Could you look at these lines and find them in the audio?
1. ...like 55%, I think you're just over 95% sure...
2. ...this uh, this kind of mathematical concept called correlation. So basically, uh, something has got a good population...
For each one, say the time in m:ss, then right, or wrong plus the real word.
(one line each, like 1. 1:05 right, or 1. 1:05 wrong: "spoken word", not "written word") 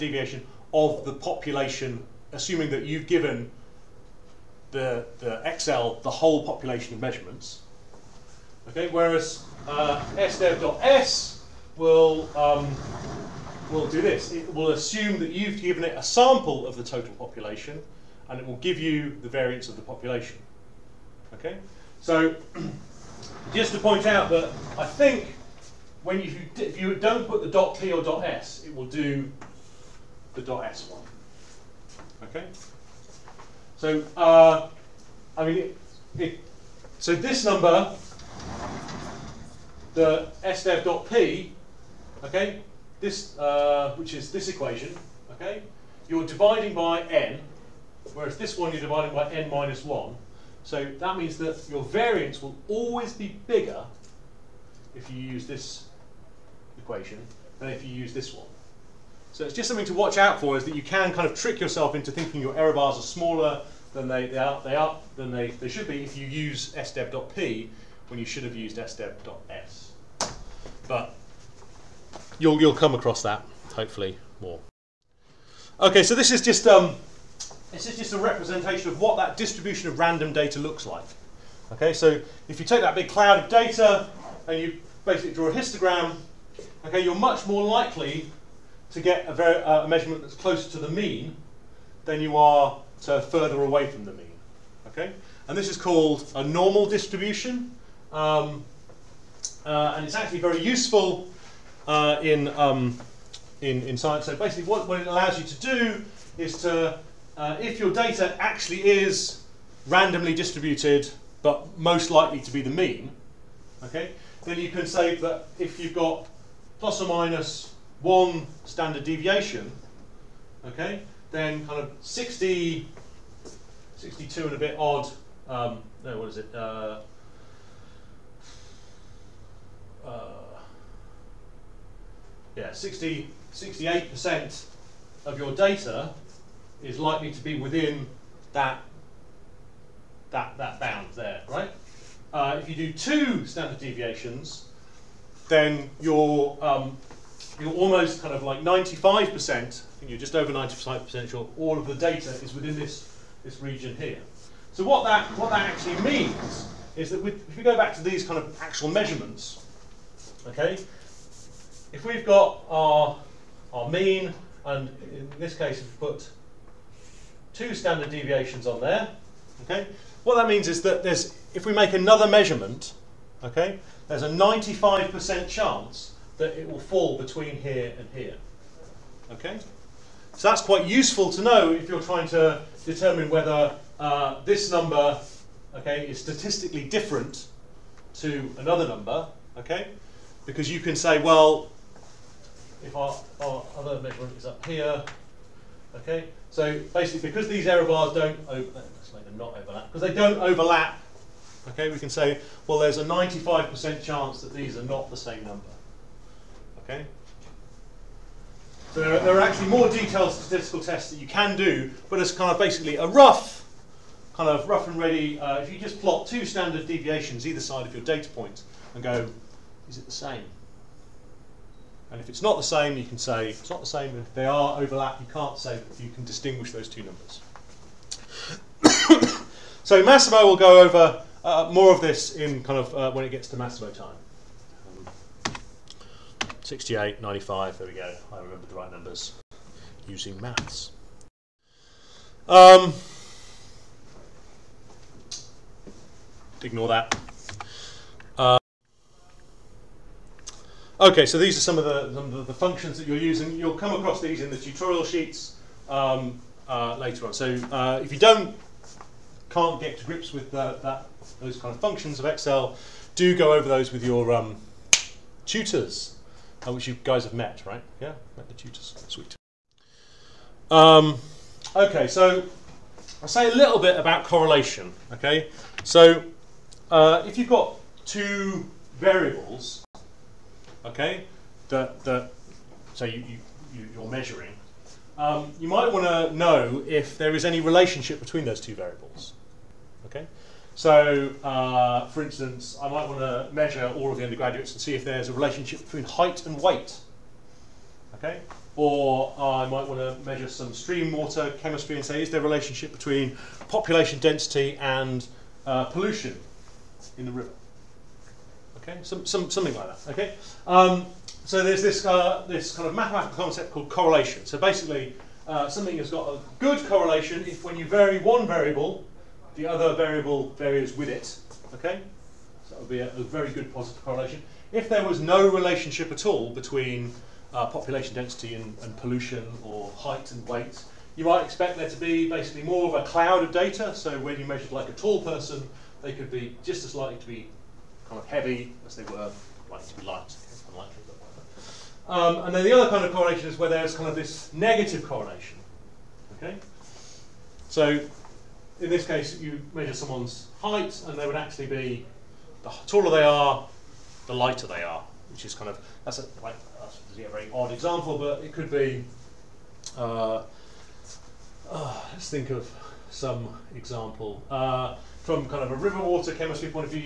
1. 2:28 wrong: "95", not "55"
2. 5:11 wrong: "correlation", not "population".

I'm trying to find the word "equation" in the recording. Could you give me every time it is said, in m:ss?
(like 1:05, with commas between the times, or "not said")
0:44, 0:56.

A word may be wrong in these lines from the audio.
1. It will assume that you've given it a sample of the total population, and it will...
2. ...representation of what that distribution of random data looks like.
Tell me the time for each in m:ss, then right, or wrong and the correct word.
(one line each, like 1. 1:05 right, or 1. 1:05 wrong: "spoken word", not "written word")
1. 0:14 right
2. 1:18 right.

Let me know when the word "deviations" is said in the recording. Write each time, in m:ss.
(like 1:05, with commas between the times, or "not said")
1:59, 2:23, 2:48, 3:36.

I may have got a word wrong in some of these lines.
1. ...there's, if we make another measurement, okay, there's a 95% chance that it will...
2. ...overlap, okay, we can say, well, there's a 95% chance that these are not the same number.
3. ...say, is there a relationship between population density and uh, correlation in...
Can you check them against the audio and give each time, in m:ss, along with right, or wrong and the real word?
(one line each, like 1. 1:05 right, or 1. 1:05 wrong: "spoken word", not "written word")
1. 2:51 right
2. 3:20 right
3. 5:02 wrong: "pollution", not "correlation".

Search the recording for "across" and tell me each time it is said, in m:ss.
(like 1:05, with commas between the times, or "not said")
1:12, 4:14.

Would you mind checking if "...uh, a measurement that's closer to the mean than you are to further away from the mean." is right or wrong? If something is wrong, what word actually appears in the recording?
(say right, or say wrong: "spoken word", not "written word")
right.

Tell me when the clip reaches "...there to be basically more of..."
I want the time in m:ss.
5:31.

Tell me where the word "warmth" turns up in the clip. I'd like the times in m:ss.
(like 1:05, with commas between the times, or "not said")
not said.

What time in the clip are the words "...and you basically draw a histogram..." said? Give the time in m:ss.
1:24.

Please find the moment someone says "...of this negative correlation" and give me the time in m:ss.
5:44.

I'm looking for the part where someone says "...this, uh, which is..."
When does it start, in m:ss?
0:43.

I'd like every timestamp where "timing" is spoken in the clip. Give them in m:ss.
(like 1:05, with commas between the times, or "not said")
not said.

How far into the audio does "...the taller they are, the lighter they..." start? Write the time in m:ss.
5:52.